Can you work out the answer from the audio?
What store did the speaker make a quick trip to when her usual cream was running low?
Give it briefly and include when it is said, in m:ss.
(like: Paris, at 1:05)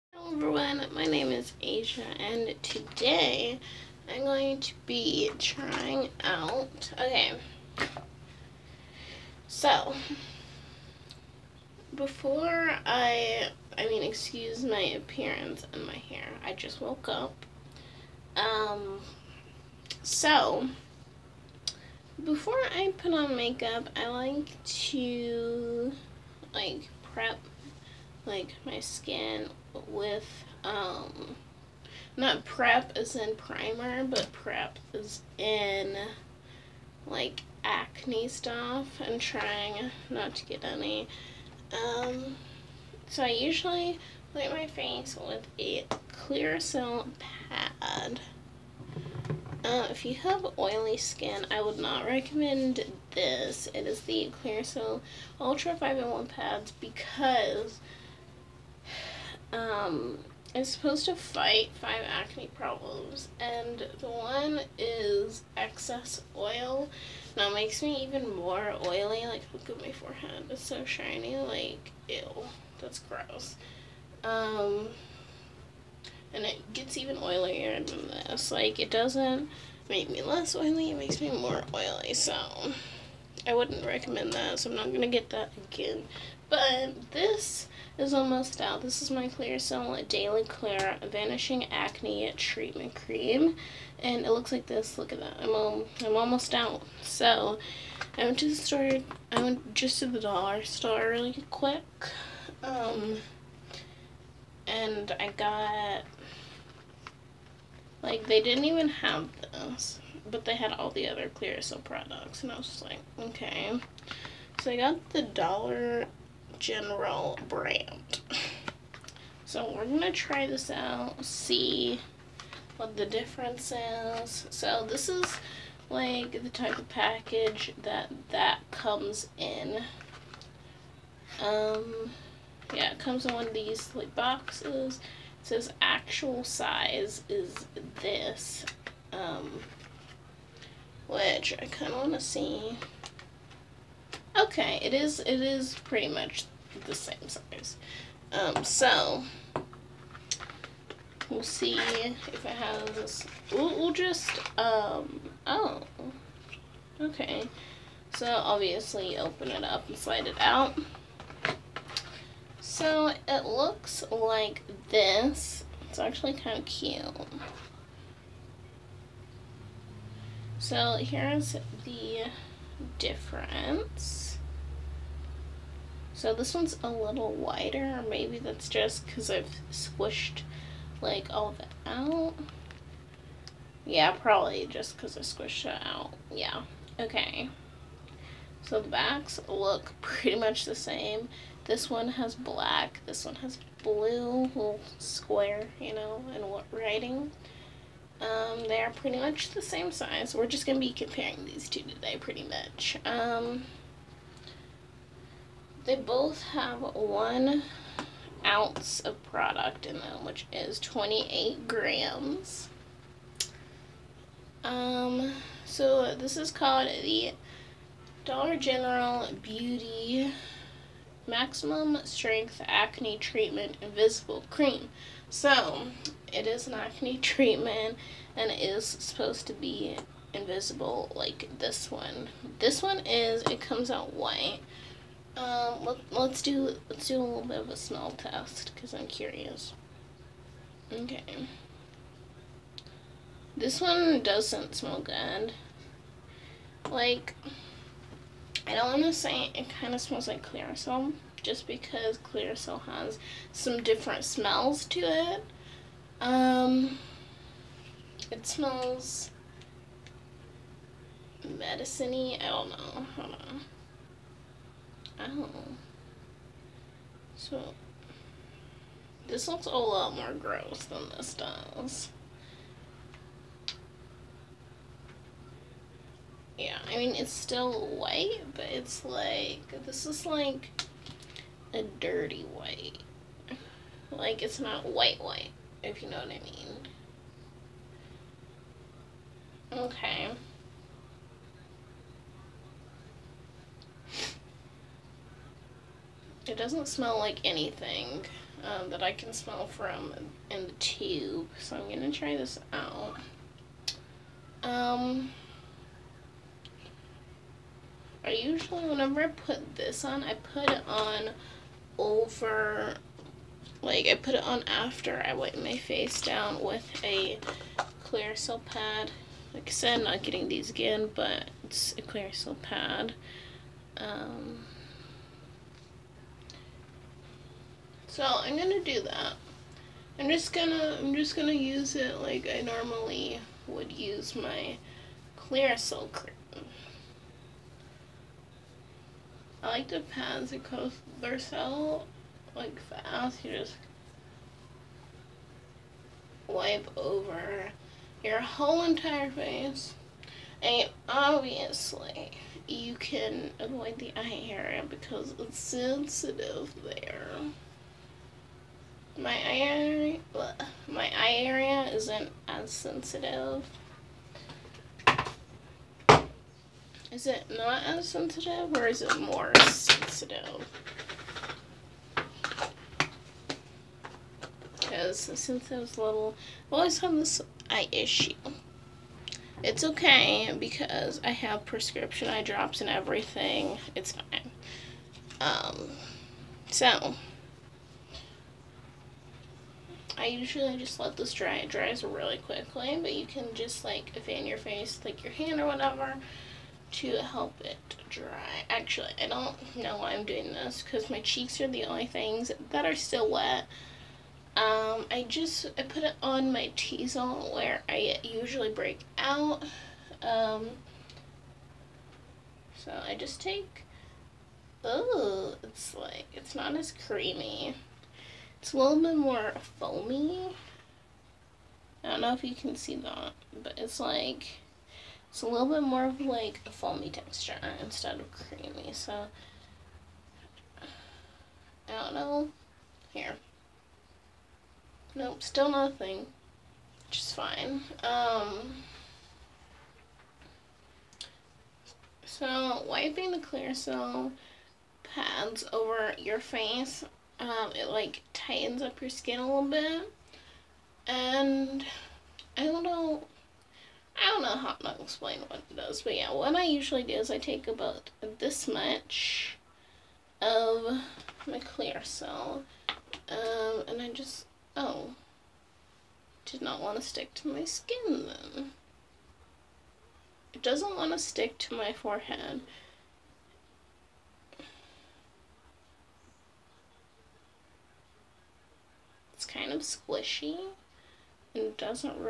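dollar store, at 1:40.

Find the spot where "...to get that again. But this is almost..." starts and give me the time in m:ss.
1:25.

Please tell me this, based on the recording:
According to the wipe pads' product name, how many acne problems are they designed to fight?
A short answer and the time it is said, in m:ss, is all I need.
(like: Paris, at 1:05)
5, at 1:01.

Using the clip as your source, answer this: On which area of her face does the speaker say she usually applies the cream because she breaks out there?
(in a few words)
T-zone.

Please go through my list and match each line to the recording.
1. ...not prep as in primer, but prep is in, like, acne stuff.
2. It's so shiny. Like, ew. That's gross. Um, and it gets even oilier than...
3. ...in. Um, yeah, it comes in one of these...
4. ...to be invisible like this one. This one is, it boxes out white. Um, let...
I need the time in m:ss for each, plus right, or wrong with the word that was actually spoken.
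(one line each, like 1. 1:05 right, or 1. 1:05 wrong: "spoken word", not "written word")
1. 0:32 right
2. 1:10 right
3. 2:09 right
4. 3:49 wrong: "comes", not "boxes".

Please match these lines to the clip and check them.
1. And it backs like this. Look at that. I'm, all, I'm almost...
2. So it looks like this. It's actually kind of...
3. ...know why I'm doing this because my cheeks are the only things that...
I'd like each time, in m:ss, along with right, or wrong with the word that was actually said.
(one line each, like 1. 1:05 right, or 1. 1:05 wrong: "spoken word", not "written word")
1. 1:34 wrong: "looks", not "backs"
2. 2:42 right
3. 6:39 right.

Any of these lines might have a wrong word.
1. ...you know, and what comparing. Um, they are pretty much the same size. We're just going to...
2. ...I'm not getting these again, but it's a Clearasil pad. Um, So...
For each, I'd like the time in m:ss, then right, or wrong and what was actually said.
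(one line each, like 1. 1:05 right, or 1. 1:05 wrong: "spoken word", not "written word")
1. 3:15 wrong: "writing", not "comparing"
2. 5:20 right.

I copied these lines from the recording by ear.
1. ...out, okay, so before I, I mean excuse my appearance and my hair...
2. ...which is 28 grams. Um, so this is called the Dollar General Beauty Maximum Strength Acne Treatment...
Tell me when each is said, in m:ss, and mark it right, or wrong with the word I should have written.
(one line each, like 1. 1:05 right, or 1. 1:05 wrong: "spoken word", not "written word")
1. 0:06 right
2. 3:30 right.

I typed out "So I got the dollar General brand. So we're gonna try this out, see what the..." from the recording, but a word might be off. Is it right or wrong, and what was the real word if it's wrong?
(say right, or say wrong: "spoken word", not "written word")
right.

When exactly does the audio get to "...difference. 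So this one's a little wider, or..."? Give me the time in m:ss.
2:52.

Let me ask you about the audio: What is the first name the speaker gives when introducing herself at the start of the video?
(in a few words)
Asia.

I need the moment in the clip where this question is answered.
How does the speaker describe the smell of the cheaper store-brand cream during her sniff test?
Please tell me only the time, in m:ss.
4:21.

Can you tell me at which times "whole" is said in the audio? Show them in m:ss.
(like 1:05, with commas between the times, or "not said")
5:48.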